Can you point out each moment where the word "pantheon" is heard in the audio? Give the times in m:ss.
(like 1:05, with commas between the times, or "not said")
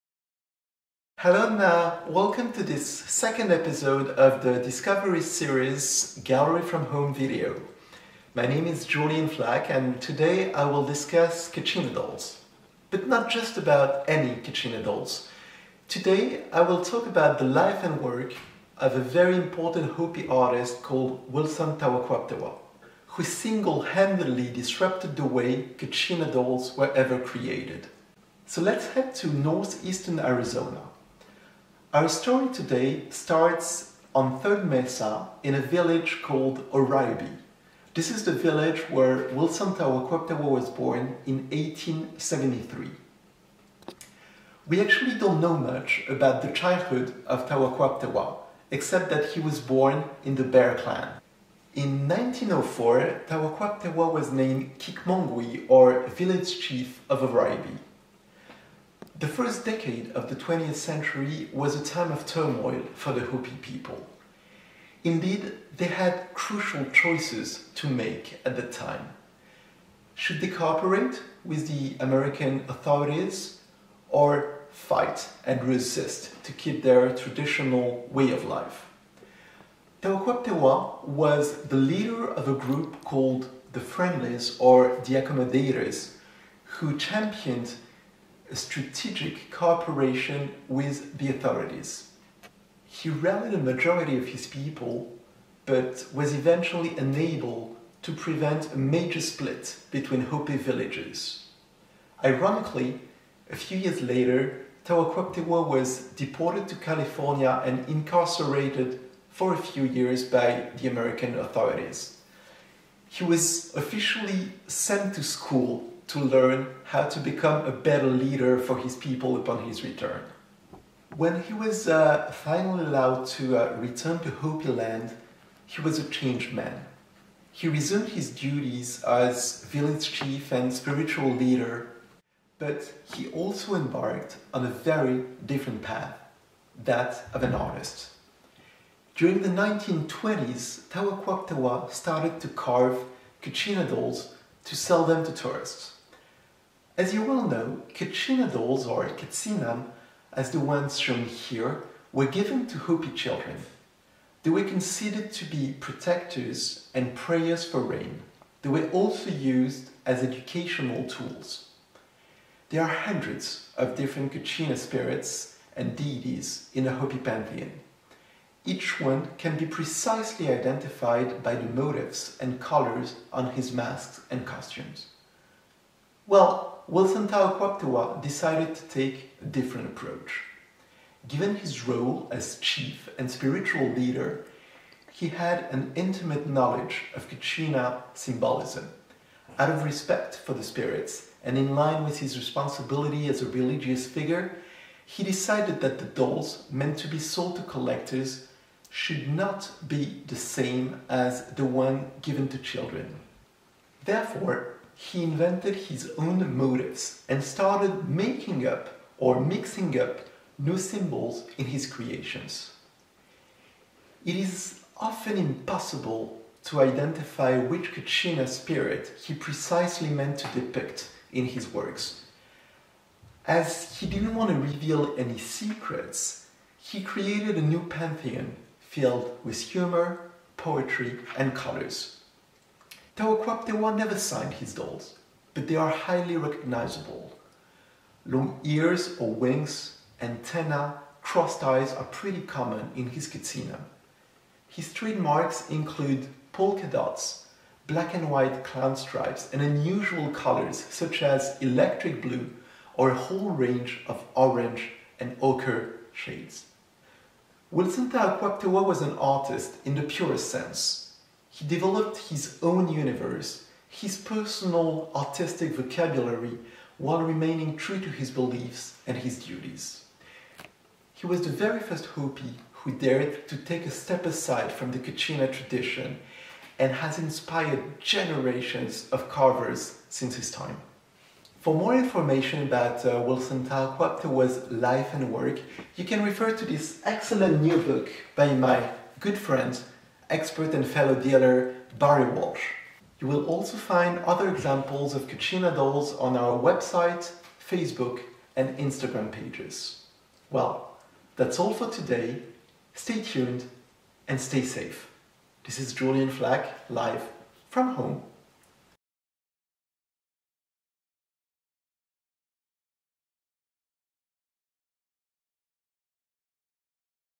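2:47, 3:47.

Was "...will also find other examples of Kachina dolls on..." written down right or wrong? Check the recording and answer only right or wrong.
right.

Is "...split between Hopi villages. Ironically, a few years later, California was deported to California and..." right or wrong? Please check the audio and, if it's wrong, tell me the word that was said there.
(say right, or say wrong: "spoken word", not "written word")
wrong: "Tawaquaptewa", not "California".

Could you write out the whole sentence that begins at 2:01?
When he was uh, finally allowed to uh, return to Hopi land, he was a changed man.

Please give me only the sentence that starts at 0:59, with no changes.
The first decade of the 20th century was a time of turmoil for the Hopi people.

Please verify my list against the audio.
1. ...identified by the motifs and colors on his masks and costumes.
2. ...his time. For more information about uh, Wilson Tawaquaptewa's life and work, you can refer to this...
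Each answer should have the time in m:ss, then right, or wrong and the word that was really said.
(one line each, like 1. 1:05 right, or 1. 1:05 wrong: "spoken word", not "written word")
1. 2:50 right
2. 4:40 right.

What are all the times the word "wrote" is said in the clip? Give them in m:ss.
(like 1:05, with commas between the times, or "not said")
not said.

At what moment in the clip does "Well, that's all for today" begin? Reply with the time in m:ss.
5:00.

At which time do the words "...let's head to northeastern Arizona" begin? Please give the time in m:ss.
0:28.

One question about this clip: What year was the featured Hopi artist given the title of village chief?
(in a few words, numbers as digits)
1904.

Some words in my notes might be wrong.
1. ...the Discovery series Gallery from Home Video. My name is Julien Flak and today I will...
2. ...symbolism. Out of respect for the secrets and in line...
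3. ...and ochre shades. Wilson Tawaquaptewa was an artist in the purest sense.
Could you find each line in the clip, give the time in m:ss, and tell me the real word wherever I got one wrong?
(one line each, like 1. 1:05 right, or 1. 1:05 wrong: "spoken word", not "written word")
1. 0:04 right
2. 3:08 wrong: "spirits", not "secrets"
3. 4:15 right.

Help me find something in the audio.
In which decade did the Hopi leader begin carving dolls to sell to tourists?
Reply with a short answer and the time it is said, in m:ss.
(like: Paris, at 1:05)
1920s, at 2:19.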